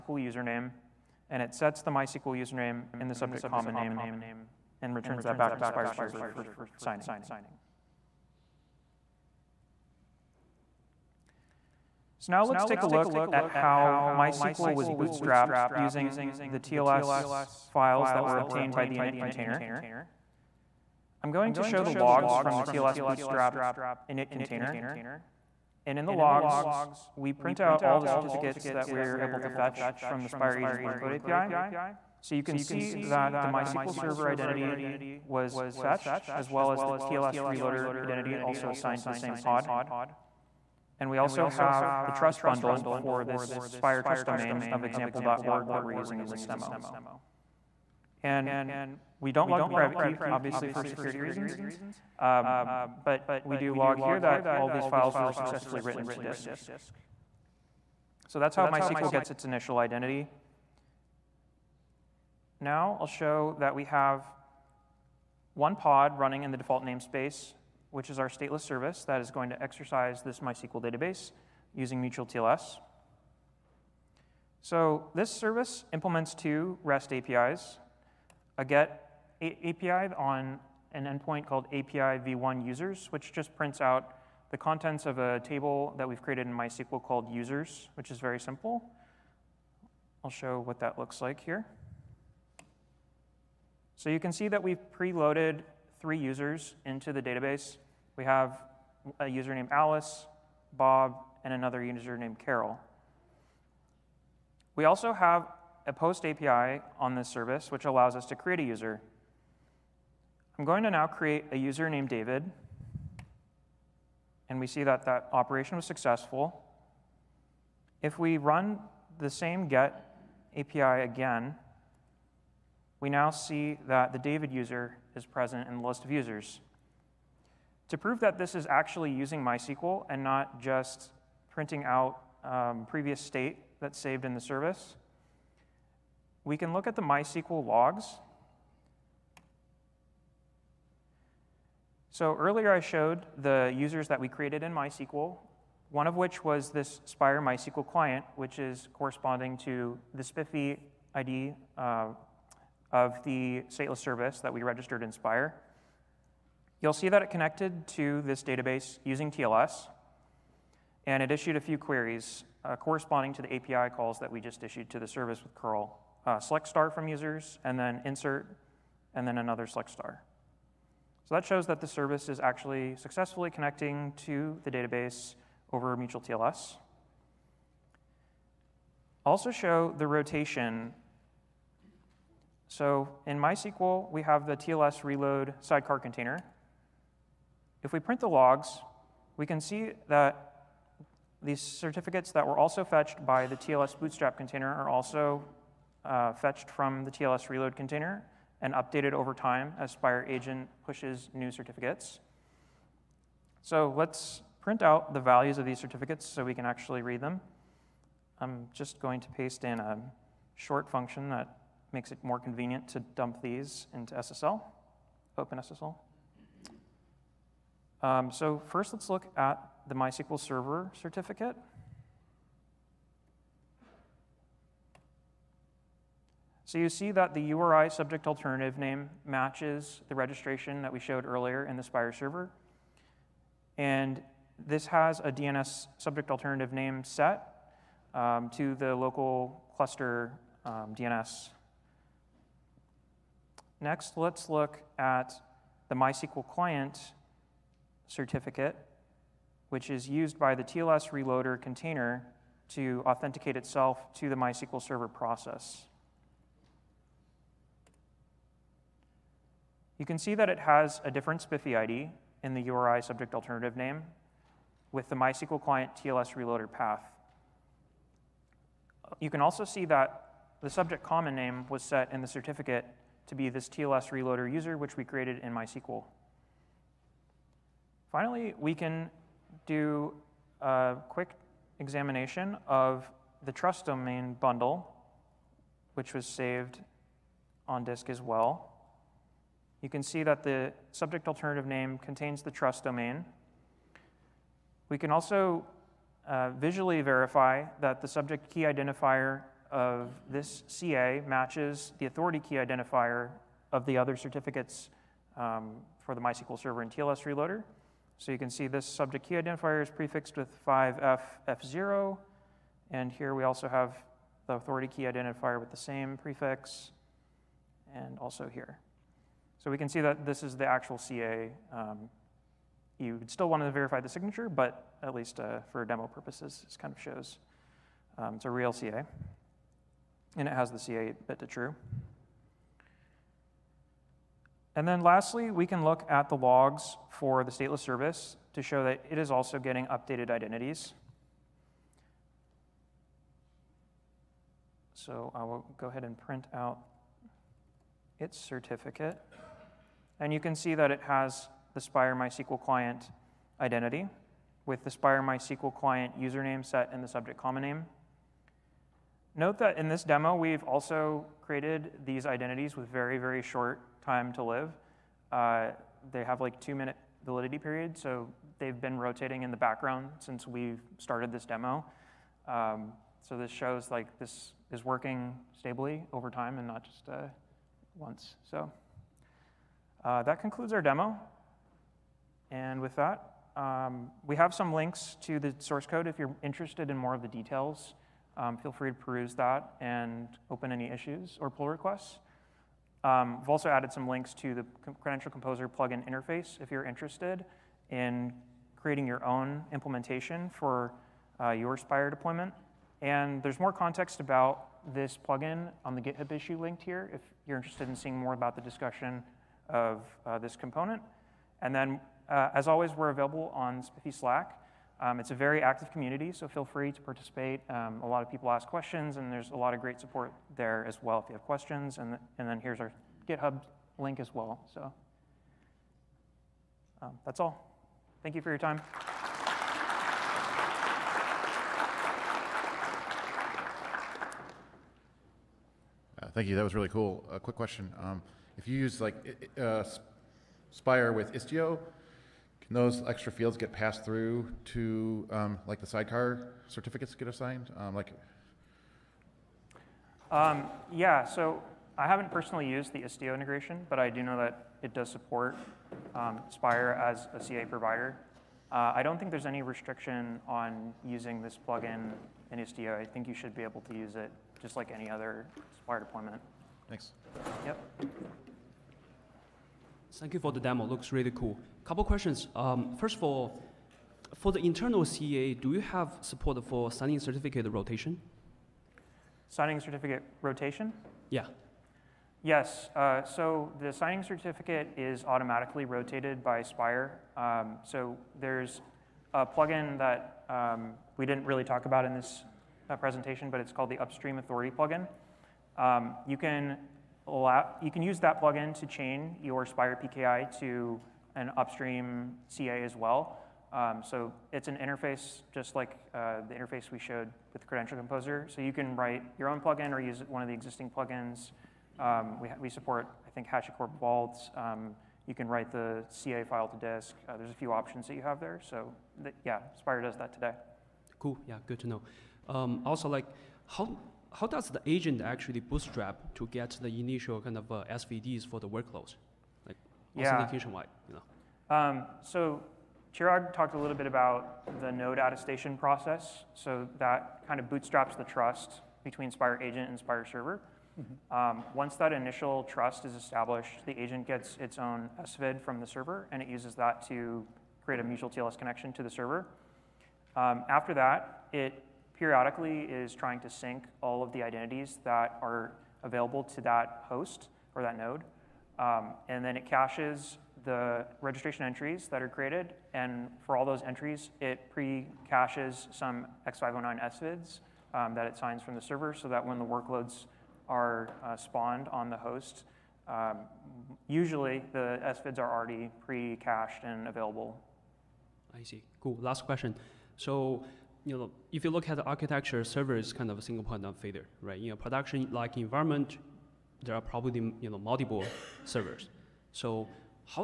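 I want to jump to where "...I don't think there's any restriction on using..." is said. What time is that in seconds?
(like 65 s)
458 s.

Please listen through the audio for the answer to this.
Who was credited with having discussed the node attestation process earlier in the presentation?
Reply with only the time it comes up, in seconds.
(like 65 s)
533 s.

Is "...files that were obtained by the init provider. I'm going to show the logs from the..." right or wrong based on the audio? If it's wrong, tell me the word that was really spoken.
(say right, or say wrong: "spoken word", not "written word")
wrong: "container", not "provider".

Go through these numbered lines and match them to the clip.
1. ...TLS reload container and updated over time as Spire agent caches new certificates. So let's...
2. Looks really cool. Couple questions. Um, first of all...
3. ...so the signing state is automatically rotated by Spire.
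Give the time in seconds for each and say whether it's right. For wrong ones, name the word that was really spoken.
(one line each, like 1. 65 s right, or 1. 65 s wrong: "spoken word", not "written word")
1. 197 s wrong: "pushes", not "caches"
2. 470 s right
3. 483 s wrong: "certificate", not "state".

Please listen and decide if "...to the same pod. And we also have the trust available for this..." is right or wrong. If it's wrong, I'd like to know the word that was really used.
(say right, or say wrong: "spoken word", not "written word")
wrong: "bundle", not "available".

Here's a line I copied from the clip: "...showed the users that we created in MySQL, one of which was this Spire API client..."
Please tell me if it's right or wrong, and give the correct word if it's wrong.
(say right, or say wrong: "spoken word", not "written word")
wrong: "MySQL", not "API".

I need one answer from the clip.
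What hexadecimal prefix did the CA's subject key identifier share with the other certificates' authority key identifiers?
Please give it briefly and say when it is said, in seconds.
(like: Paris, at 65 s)
5FF0, at 310 s.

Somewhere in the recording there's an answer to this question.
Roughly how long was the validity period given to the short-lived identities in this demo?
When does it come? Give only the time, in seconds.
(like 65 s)
366 s.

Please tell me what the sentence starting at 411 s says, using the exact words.
And then, uh, as always, we're available on SPIFFE Slack.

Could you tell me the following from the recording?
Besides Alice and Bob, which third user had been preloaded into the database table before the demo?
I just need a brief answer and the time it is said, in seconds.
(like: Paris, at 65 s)
Carol, at 102 s.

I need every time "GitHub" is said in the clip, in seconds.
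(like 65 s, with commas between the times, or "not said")
406 s, 423 s.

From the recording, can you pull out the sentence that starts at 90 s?
I'll show what that looks like here.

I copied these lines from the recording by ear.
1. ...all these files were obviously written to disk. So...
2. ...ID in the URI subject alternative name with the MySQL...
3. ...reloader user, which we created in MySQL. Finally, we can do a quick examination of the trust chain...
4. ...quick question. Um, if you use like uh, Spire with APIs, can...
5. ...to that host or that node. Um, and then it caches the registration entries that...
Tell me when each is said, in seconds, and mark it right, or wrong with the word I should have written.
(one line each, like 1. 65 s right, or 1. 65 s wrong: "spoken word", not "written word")
1. 54 s wrong: "successfully", not "obviously"
2. 261 s right
3. 274 s wrong: "domain", not "chain"
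4. 437 s wrong: "Istio", not "APIs"
5. 556 s right.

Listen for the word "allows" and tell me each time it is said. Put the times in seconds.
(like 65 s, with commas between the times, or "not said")
107 s, 497 s.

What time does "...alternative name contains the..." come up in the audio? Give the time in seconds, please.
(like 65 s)
291 s.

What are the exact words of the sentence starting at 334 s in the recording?
And then lastly, we can look at the logs for the stateless service to show that it is also getting updated identities.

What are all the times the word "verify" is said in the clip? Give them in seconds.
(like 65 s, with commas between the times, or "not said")
297 s, 323 s.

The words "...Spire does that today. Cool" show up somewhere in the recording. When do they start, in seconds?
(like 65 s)
519 s.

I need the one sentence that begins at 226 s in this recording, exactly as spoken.
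So you see that the URI subject alternative name matches the registration that we showed earlier in the Spire server.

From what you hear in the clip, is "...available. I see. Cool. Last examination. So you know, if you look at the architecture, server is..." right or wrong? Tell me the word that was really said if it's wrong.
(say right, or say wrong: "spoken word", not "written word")
wrong: "question", not "examination".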